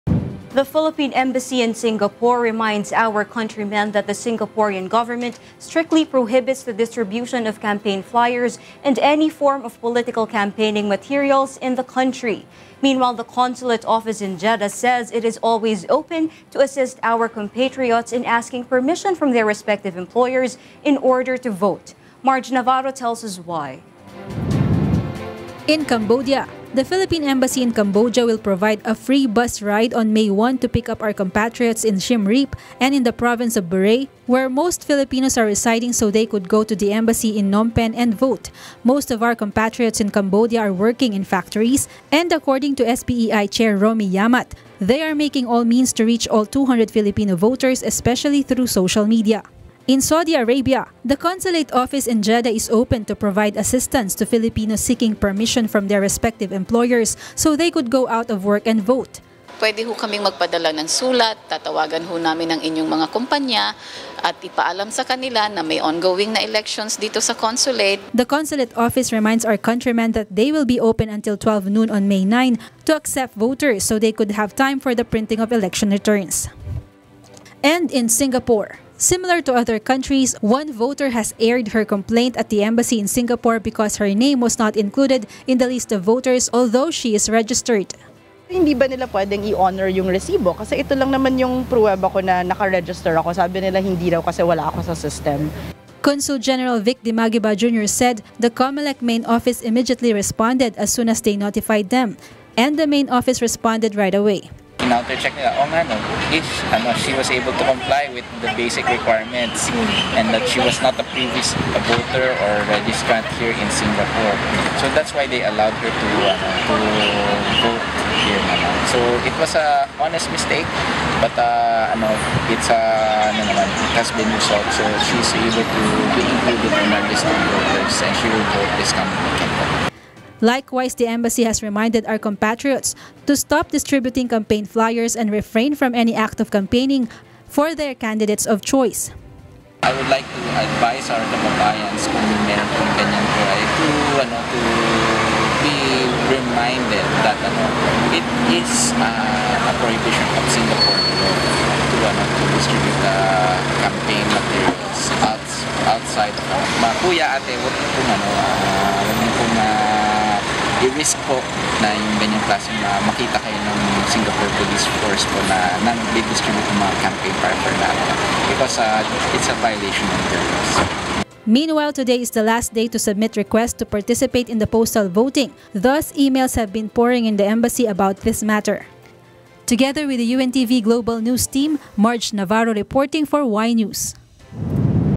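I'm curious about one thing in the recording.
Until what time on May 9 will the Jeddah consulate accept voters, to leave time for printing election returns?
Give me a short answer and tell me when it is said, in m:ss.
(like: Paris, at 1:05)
12 noon, at 1:11.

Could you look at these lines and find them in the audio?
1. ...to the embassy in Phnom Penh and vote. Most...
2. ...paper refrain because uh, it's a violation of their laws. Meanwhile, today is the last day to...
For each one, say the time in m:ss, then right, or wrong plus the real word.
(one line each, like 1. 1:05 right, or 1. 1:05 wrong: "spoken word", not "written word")
1. 0:36 right
2. 2:47 wrong: "natin", not "refrain".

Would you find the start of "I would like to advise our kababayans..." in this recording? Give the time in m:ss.
2:19.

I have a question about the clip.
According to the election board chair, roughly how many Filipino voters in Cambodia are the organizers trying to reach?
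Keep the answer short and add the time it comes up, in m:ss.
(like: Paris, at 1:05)
200, at 0:46.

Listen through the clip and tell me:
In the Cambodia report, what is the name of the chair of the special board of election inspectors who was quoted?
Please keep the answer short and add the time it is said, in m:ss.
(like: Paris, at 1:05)
Romy Yamat, at 0:43.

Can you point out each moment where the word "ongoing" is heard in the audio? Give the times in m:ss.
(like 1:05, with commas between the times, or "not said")
1:05.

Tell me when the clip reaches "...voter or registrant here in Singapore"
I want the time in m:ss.
1:51.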